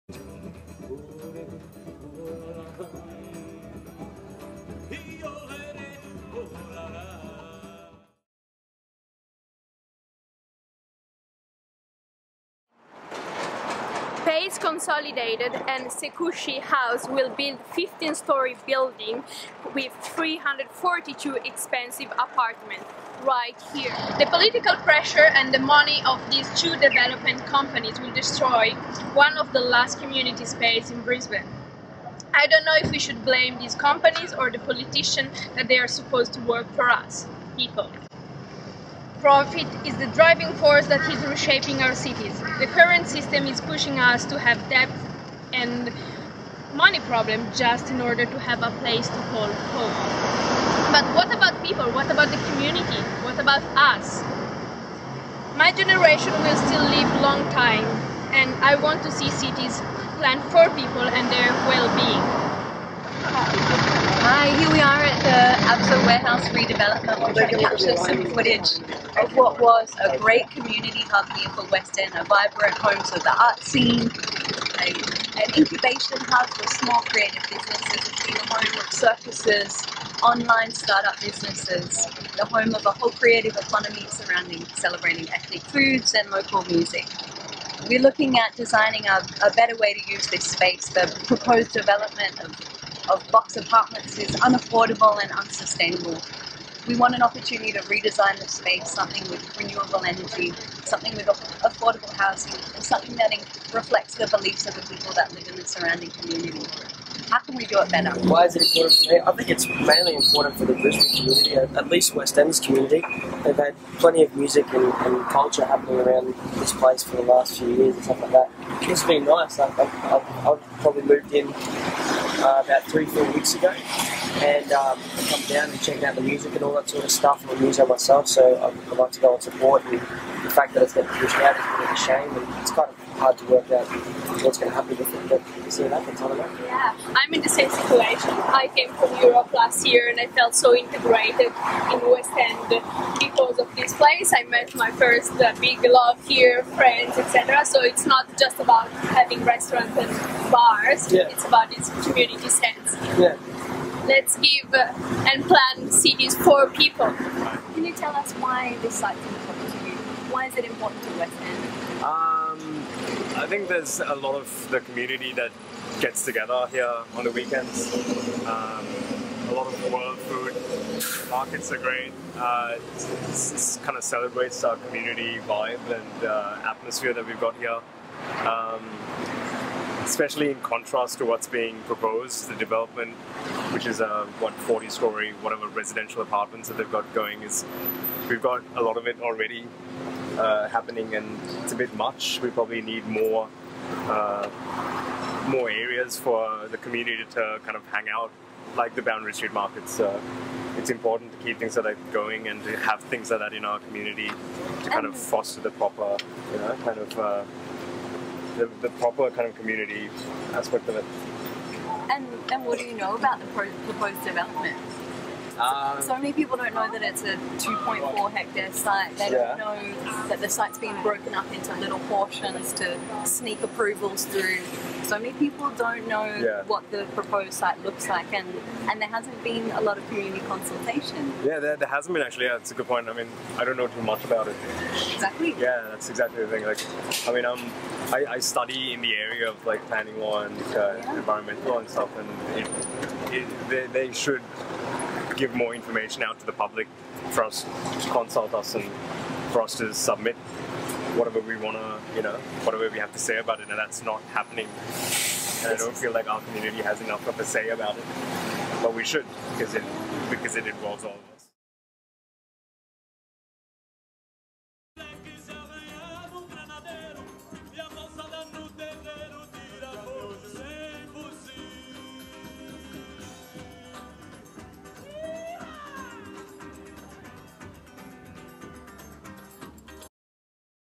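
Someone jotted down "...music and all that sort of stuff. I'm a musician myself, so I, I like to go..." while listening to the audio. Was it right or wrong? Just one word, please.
right.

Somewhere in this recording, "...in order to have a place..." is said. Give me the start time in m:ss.
0:47.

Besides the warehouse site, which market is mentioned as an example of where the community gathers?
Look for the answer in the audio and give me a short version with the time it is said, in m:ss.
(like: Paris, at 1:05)
Boundary Street Markets, at 3:19.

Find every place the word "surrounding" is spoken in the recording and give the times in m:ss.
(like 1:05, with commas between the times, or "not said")
1:24, 1:45.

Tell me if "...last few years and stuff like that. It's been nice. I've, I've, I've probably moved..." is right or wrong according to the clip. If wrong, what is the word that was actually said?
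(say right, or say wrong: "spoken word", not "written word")
right.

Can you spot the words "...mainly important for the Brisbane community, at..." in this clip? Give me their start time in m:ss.
1:49.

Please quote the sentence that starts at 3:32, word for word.
And, and what do you know about the proposed development?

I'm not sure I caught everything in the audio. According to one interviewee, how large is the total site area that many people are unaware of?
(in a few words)
2.4 hectares.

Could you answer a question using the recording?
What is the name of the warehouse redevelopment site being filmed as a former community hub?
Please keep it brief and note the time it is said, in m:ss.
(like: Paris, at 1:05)
Absoe Warehouse, at 1:05.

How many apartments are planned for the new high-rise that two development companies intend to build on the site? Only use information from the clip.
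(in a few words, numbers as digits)
342.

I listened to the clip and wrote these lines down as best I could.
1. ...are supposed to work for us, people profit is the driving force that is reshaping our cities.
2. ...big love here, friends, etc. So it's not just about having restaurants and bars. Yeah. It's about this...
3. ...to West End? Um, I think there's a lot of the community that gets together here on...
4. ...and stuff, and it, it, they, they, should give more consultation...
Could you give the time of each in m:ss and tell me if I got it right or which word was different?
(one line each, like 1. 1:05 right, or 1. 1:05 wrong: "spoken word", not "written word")
1. 0:35 right
2. 2:25 right
3. 2:41 right
4. 4:01 wrong: "information", not "consultation".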